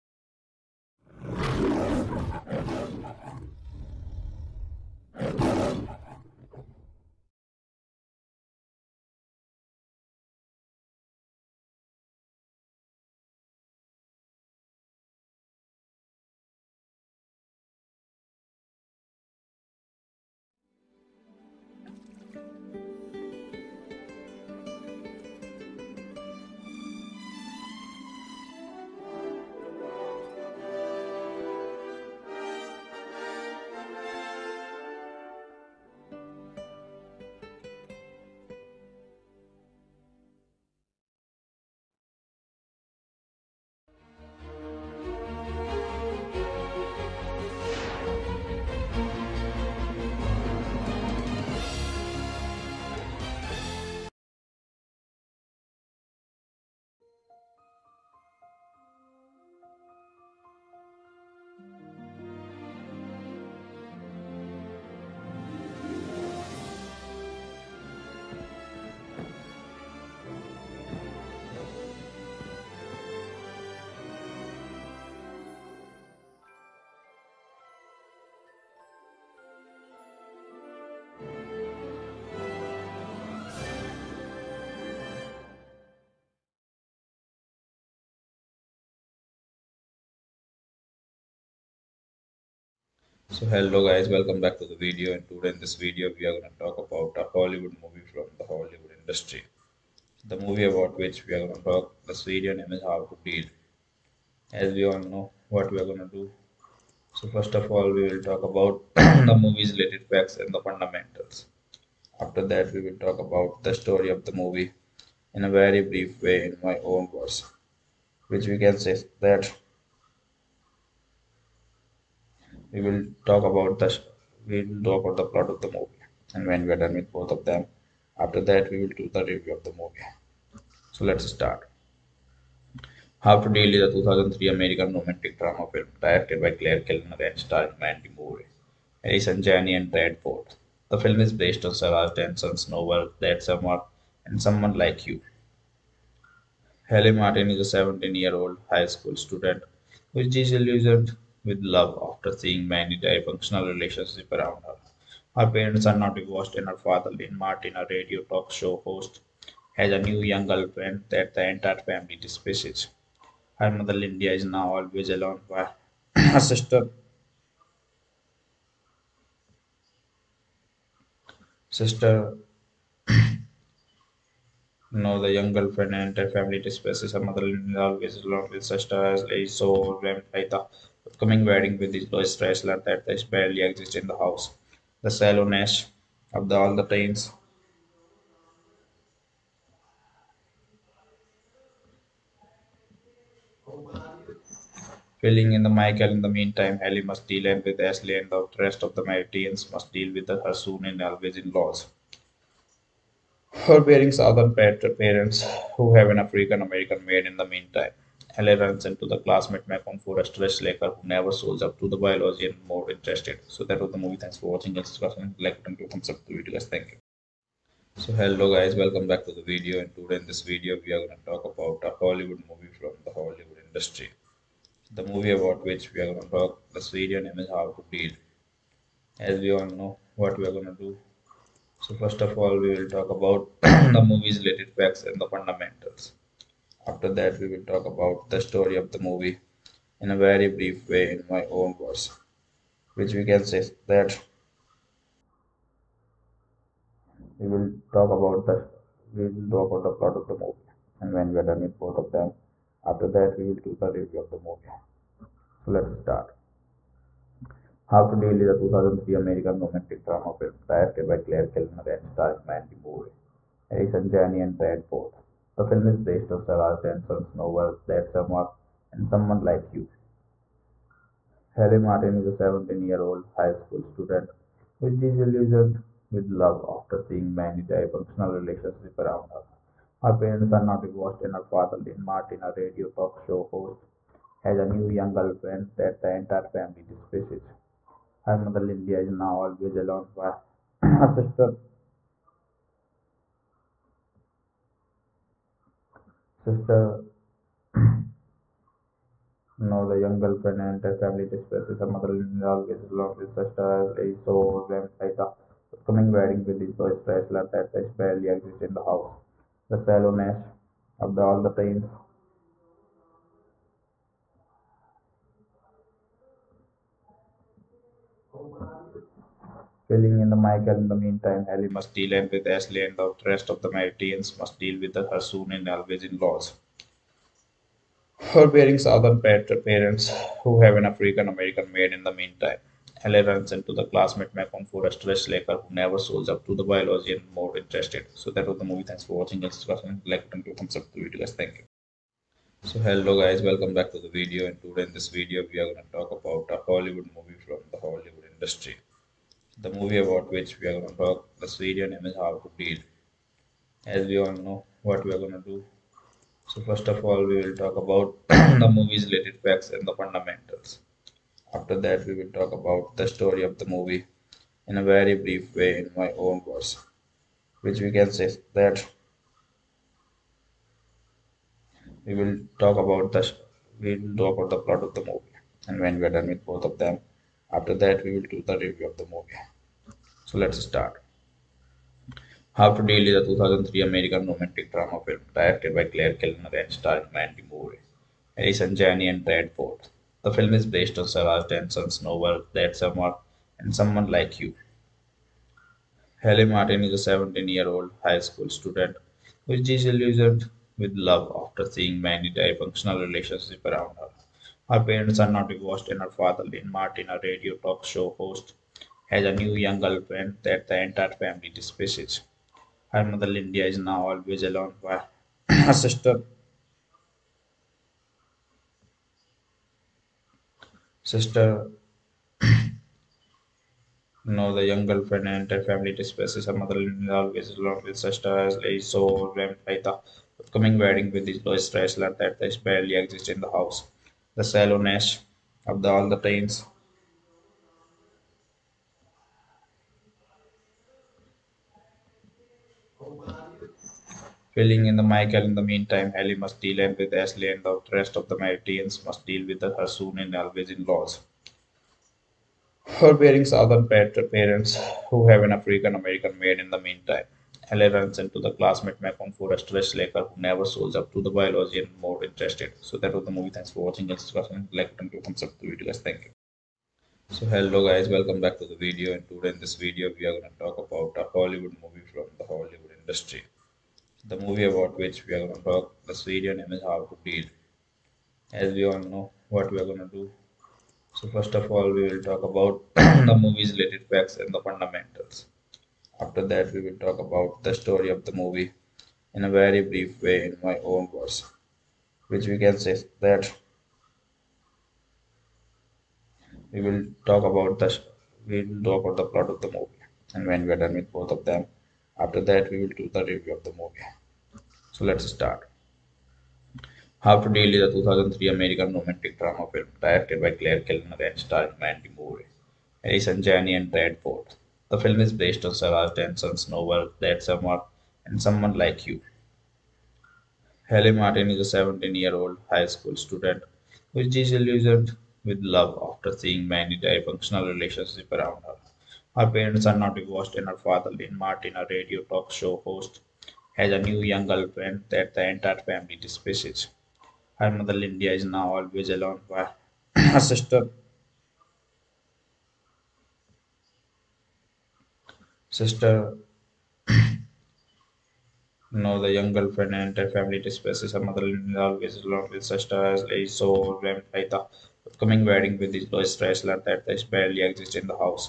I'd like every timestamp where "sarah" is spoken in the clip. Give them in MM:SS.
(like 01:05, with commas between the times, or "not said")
02:21, 04:26, 06:31, 08:35.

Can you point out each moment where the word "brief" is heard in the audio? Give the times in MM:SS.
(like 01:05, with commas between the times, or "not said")
01:55, 04:00, 06:05, 08:09.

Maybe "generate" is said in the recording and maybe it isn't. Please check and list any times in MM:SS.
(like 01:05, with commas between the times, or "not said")
not said.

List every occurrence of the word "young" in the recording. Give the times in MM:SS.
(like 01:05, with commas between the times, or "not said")
02:40, 02:55, 04:44, 04:59, 06:49, 07:04, 08:54, 09:09.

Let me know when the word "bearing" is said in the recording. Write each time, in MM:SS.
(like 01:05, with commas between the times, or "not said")
03:23, 05:28, 07:33.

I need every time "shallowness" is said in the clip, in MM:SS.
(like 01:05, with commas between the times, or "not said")
03:05, 05:09, 07:14.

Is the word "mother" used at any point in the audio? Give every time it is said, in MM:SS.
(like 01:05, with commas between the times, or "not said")
02:43, 02:57, 04:48, 05:01, 06:53, 07:06, 08:57, 09:11.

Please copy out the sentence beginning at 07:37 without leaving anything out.
Halle runs into the classmate Macon for a stress, Laker who never shows up to the biology and more interested.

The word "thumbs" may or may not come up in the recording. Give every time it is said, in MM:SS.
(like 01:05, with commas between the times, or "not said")
03:35, 05:40, 07:45.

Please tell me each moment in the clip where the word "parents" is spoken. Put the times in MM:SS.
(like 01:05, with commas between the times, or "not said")
02:35, 03:24, 04:40, 05:29, 06:44, 07:34, 08:49.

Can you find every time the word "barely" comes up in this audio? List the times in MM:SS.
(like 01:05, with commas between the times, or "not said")
03:03, 05:07, 07:12, 09:17.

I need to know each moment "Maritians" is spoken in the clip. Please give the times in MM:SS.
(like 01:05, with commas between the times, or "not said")
03:19, 05:23, 07:28.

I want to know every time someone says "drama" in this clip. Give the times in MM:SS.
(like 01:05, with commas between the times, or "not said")
02:15, 04:20, 06:24, 08:29.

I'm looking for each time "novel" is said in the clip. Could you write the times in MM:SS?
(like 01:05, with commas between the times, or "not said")
02:22, 04:27, 06:32, 08:36.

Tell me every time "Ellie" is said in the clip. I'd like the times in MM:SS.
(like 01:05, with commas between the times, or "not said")
03:16, 05:21, 05:33, 07:26.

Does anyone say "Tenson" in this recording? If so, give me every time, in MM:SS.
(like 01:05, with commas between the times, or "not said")
04:26, 08:36.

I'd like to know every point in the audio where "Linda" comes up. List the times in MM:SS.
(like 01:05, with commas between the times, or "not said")
02:43, 02:57, 04:48, 06:53, 08:57.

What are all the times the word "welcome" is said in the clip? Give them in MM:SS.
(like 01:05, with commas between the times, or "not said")
01:34, 03:38, 05:43, 07:48.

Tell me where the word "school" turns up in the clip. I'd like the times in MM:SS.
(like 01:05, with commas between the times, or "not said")
02:28, 04:33, 06:38, 08:42.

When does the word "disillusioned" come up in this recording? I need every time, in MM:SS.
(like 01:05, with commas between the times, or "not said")
02:30, 04:34, 06:39, 08:44.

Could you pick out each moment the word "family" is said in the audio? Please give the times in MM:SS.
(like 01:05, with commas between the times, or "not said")
02:41, 02:56, 04:46, 05:00, 06:51, 07:05, 08:55, 09:10.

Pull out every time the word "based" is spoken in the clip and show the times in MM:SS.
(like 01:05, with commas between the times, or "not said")
02:21, 04:25, 06:30, 08:35.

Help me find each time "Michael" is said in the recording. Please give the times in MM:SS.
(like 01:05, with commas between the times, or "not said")
03:15, 05:20, 07:25.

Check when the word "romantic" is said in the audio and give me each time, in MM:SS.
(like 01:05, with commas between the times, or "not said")
02:14, 04:19, 06:24, 08:28.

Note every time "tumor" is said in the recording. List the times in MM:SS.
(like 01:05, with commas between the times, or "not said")
not said.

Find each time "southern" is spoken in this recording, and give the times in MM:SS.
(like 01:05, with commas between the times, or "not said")
03:24, 05:28.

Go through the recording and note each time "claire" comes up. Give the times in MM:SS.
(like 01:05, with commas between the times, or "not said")
02:16, 04:21, 06:25, 08:30.